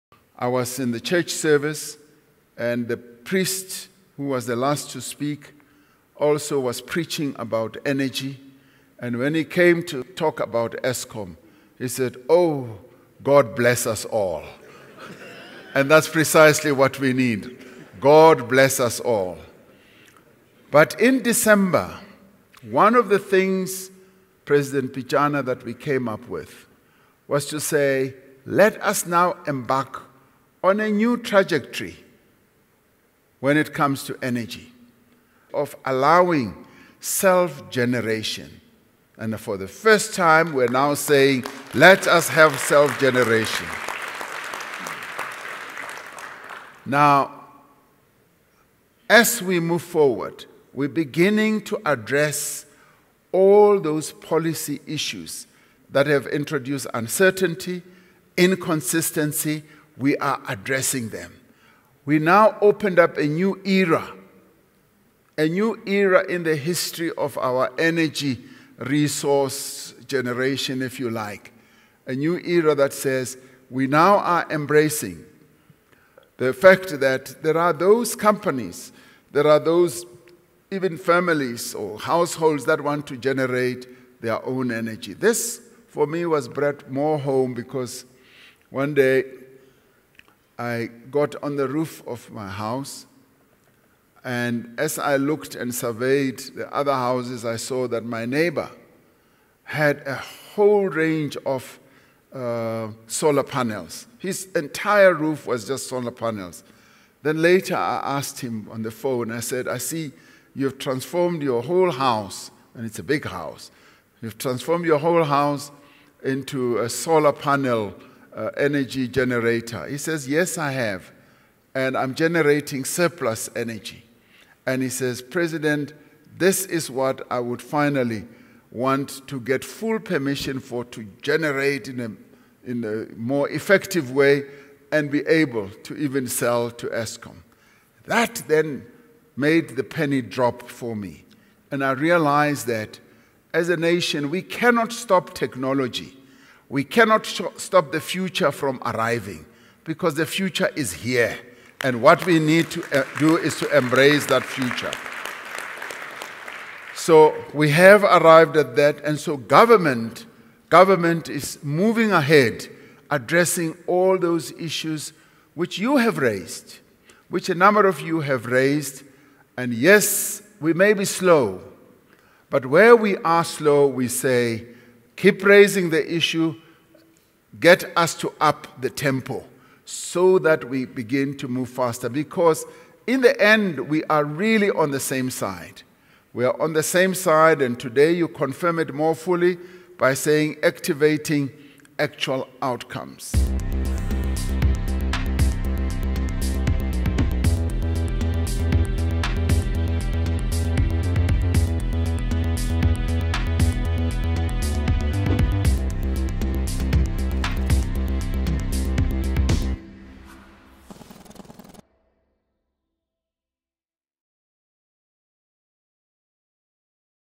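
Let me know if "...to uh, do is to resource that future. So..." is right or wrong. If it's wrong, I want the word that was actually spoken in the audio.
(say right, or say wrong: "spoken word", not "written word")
wrong: "embrace", not "resource".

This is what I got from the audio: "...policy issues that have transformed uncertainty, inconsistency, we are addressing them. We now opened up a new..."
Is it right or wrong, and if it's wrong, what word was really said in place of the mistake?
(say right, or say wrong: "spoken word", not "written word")
wrong: "introduced", not "transformed".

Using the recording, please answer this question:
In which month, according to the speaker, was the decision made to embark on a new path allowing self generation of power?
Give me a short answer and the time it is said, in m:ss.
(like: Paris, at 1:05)
December, at 0:21.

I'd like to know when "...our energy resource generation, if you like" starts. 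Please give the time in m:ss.
1:07.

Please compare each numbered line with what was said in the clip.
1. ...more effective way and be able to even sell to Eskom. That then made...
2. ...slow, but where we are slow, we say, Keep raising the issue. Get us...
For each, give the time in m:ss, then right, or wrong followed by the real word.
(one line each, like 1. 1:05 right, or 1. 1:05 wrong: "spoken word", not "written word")
1. 2:13 right
2. 2:51 right.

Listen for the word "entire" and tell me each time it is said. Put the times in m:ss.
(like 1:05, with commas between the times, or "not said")
1:44.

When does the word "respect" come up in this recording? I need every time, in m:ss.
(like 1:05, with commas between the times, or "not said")
not said.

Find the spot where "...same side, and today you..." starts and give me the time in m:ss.
3:06.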